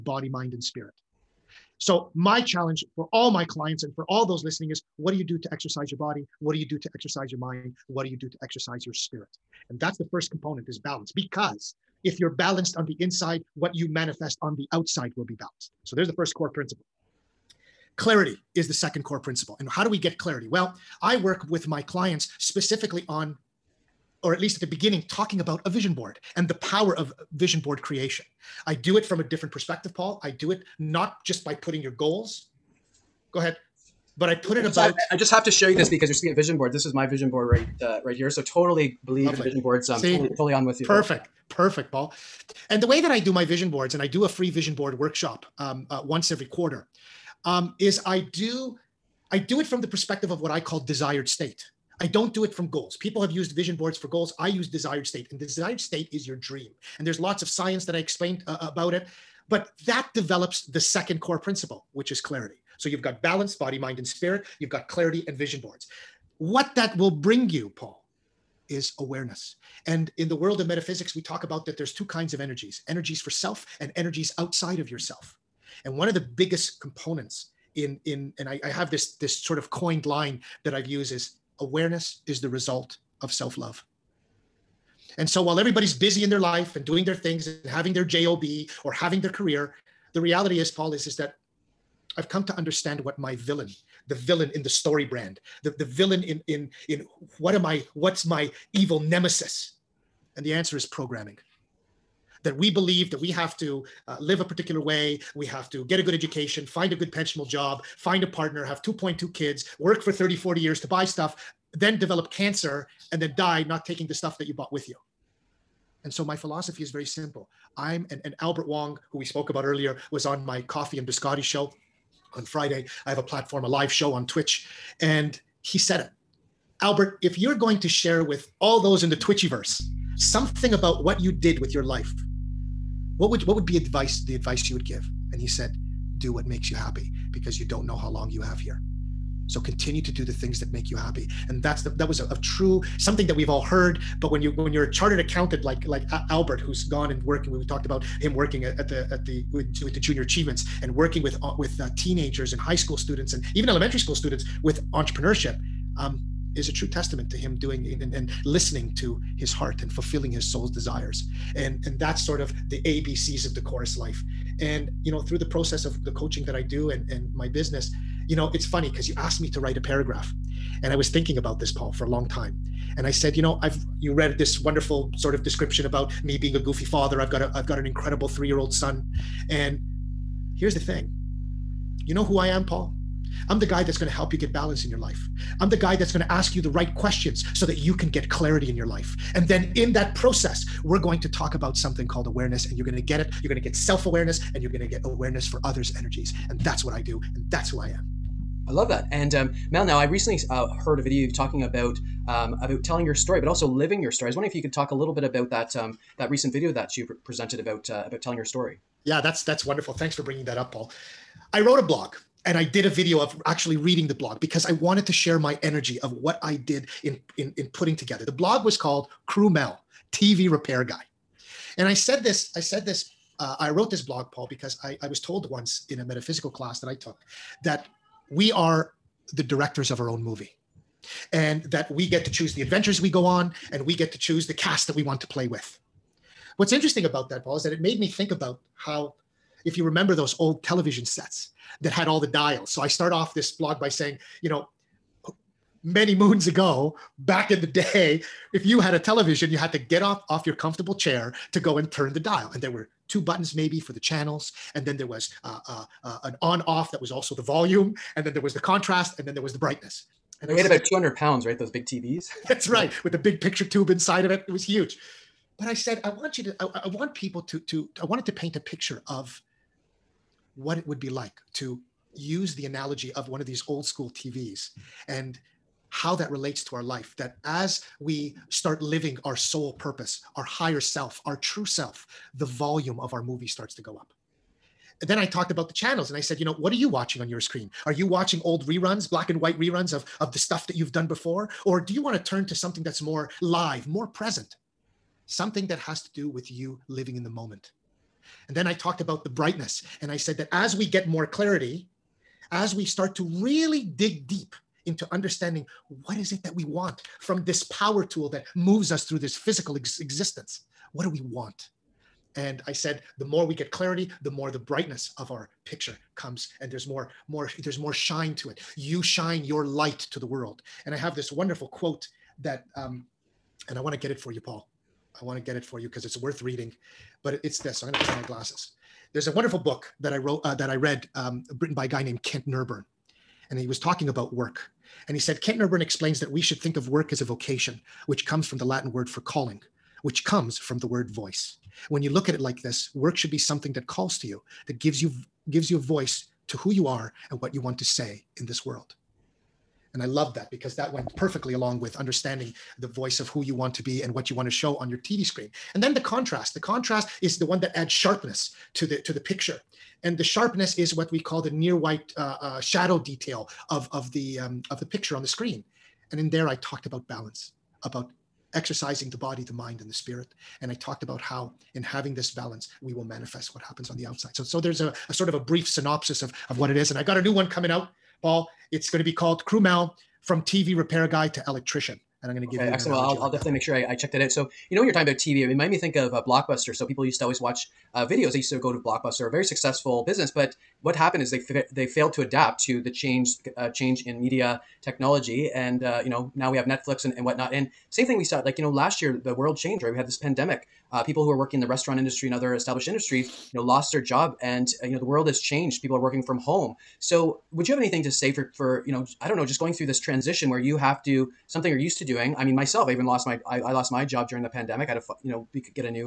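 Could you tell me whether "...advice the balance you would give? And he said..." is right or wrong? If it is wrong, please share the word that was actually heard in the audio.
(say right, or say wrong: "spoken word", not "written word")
wrong: "advice", not "balance".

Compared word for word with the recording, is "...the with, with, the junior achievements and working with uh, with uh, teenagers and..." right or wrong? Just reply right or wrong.
right.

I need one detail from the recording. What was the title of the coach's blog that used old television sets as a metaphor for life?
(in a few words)
Kru Mel, TV repair guy.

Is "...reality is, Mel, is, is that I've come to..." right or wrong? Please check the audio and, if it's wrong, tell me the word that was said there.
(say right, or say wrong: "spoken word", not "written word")
wrong: "Paul", not "Mel".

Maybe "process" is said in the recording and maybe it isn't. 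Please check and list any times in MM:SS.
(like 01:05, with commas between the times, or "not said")
02:45, 03:10.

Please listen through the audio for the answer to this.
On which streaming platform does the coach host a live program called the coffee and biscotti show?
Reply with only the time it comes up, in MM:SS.
02:04.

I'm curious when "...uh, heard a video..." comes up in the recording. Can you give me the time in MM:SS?
03:20.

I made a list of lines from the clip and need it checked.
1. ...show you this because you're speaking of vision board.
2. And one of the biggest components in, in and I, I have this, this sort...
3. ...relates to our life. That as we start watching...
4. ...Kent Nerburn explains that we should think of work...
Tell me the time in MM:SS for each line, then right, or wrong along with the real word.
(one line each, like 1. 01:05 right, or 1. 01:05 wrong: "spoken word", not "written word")
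1. 00:35 right
2. 01:15 right
3. 04:36 wrong: "living", not "watching"
4. 05:35 right.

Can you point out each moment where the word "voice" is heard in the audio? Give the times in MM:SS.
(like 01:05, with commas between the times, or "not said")
05:41, 05:45, 05:52.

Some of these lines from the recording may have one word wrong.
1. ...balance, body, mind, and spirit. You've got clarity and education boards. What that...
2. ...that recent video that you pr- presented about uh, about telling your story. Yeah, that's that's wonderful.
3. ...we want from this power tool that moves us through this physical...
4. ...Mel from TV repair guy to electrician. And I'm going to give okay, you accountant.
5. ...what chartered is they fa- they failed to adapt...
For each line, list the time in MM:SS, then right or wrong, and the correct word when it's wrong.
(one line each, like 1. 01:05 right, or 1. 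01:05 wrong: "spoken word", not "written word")
1. 01:03 wrong: "vision", not "education"
2. 03:26 right
3. 05:06 right
4. 06:19 wrong: "excellent", not "accountant"
5. 06:30 wrong: "happened", not "chartered".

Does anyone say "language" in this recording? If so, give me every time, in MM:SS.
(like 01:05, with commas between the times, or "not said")
not said.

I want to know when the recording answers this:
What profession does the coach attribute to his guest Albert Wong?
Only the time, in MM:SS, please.
02:24.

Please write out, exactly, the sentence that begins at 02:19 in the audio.
So continue to do the things that make you happy.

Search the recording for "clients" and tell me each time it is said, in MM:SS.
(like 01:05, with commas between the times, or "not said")
00:03, 00:21.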